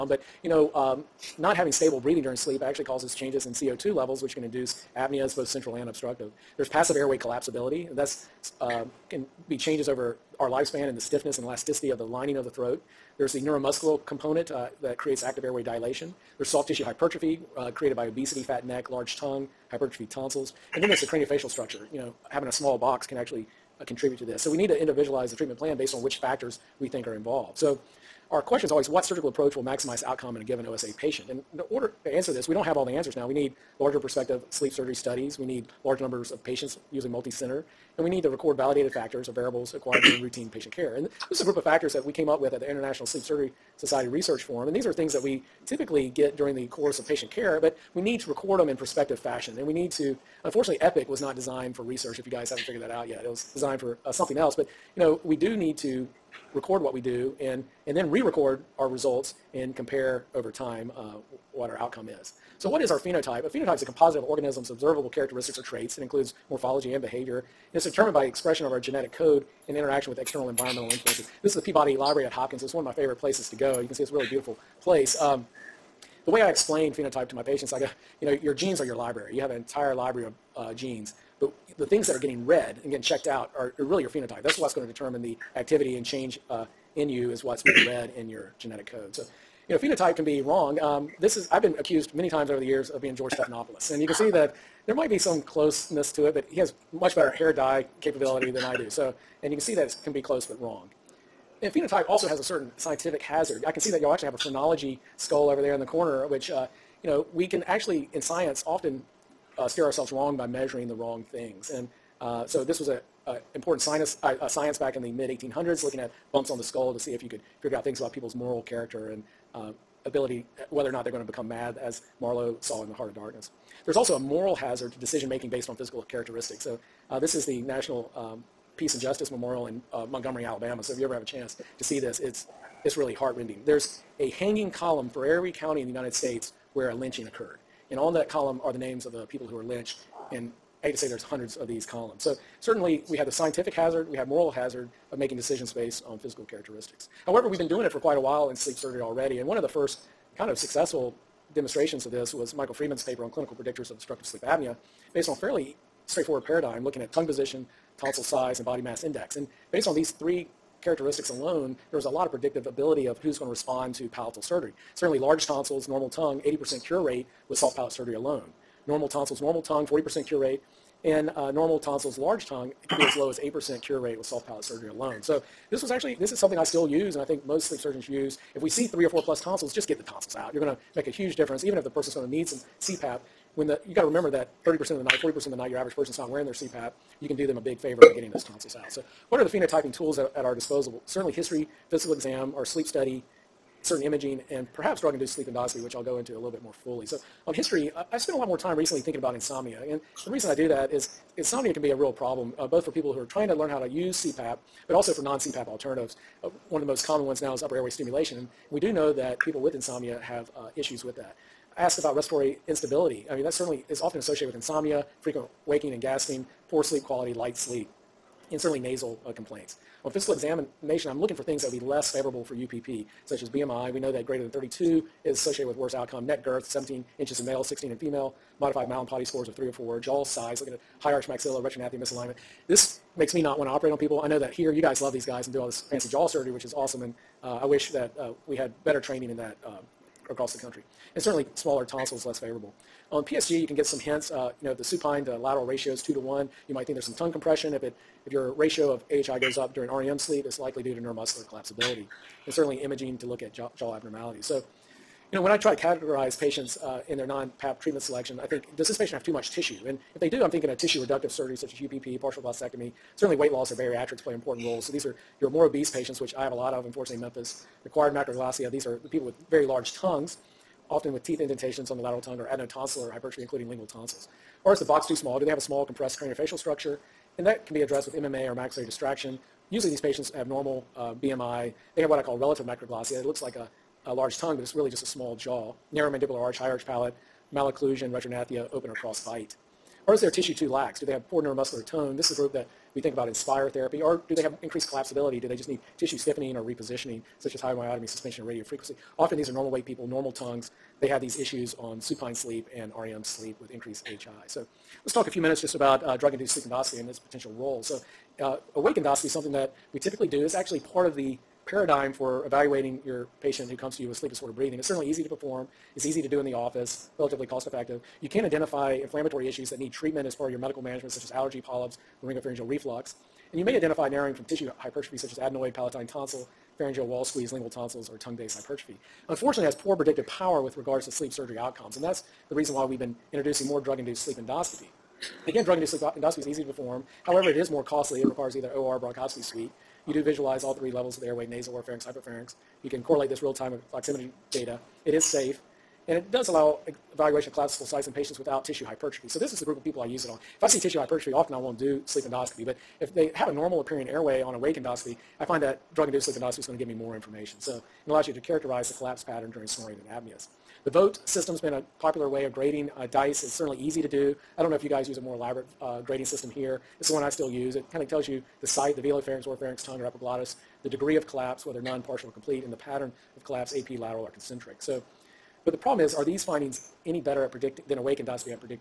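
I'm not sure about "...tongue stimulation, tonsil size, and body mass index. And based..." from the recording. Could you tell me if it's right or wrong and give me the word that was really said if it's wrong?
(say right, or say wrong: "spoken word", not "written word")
wrong: "position", not "stimulation".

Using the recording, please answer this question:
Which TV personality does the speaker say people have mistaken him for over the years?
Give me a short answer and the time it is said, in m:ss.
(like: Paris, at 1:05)
George Stephanopoulos, at 1:33.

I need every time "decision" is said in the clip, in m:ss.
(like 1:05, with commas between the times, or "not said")
2:04, 2:25.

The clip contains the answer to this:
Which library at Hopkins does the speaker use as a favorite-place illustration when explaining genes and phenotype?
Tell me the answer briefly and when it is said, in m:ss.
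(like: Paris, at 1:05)
Peabody Library, at 1:11.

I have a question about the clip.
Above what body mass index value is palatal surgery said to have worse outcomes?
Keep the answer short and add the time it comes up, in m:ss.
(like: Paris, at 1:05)
32, at 3:44.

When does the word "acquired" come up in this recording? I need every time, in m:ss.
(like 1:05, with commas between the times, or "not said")
0:39, 4:27.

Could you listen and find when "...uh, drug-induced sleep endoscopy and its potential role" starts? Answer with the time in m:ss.
5:06.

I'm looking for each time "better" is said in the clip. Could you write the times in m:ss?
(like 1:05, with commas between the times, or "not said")
1:37, 3:58, 6:17.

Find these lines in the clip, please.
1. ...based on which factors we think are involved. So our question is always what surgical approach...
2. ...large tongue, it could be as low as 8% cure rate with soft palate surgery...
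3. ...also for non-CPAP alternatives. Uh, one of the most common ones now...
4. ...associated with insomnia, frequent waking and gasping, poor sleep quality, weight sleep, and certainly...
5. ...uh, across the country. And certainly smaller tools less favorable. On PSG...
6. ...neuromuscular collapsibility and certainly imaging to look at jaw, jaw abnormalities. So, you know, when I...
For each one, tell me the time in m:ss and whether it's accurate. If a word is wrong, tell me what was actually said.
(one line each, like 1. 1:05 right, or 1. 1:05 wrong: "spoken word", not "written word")
1. 0:25 right
2. 2:52 right
3. 3:24 right
4. 3:34 wrong: "light", not "weight"
5. 3:59 wrong: "tonsils", not "tools"
6. 4:10 right.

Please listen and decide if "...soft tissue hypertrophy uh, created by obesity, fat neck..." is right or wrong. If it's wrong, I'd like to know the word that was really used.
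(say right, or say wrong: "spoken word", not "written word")
right.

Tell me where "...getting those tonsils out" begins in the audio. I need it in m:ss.
3:08.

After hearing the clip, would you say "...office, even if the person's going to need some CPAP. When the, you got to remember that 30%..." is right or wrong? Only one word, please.
wrong.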